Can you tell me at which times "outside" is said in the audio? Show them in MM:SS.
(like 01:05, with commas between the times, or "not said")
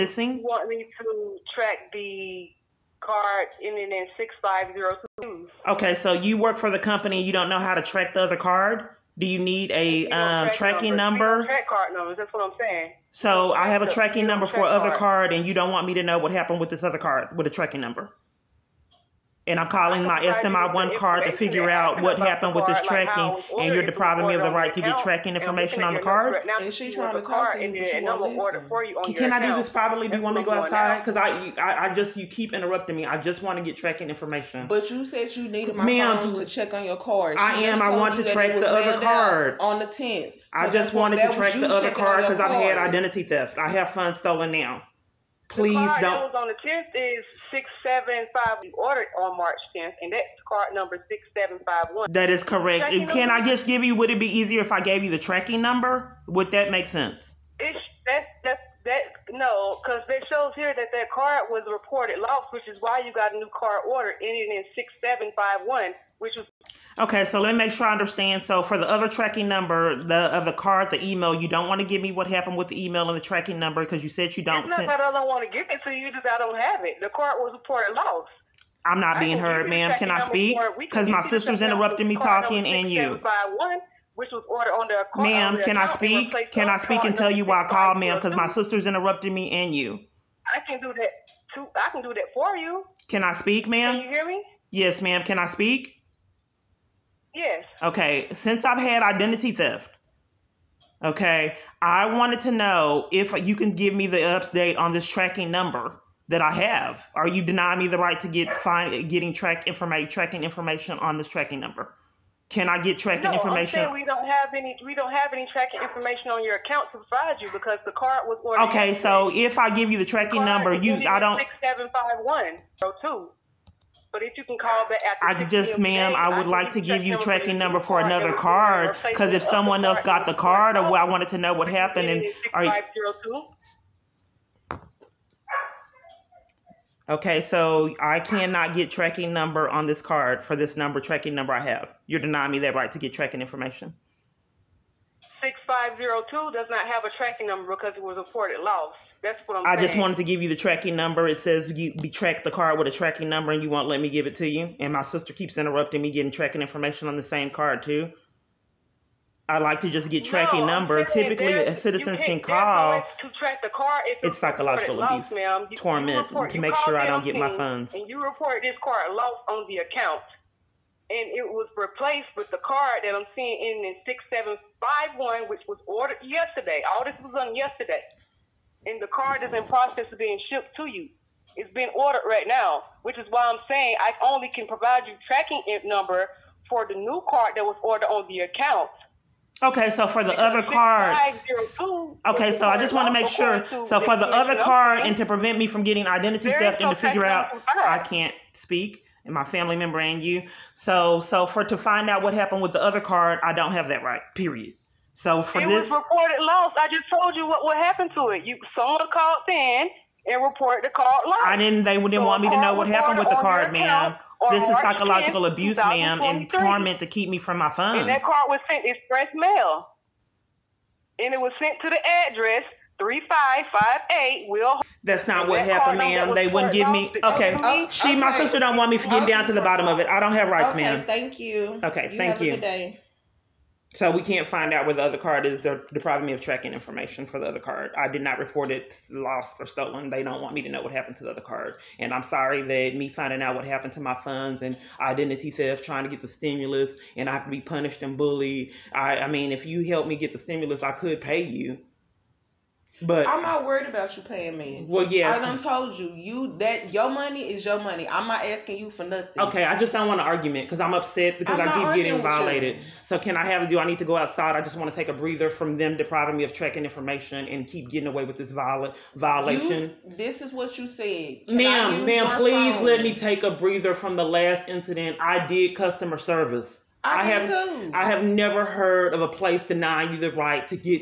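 00:30, 04:24.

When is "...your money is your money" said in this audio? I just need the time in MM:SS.
04:16.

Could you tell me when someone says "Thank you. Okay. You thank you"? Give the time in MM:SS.
03:51.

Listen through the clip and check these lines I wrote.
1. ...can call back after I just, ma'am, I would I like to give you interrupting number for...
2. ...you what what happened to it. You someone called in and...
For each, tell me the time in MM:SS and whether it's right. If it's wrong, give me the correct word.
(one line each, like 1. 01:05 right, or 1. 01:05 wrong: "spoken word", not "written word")
1. 02:04 wrong: "tracking", not "interrupting"
2. 03:27 right.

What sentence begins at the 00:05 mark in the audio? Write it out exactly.
Okay, so you work for the company.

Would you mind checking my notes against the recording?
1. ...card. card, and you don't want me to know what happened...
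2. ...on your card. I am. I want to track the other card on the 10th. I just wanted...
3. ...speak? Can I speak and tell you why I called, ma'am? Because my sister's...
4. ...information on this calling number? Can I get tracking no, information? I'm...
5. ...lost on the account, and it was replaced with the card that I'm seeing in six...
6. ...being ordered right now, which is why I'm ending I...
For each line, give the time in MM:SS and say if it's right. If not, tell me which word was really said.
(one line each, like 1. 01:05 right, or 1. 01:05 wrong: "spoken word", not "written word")
1. 00:14 right
2. 00:36 right
3. 01:25 right
4. 01:50 wrong: "tracking", not "calling"
5. 02:49 right
6. 03:01 wrong: "saying", not "ending".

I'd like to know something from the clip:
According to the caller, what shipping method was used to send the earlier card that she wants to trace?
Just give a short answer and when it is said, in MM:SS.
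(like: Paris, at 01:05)
express mail, at 03:38.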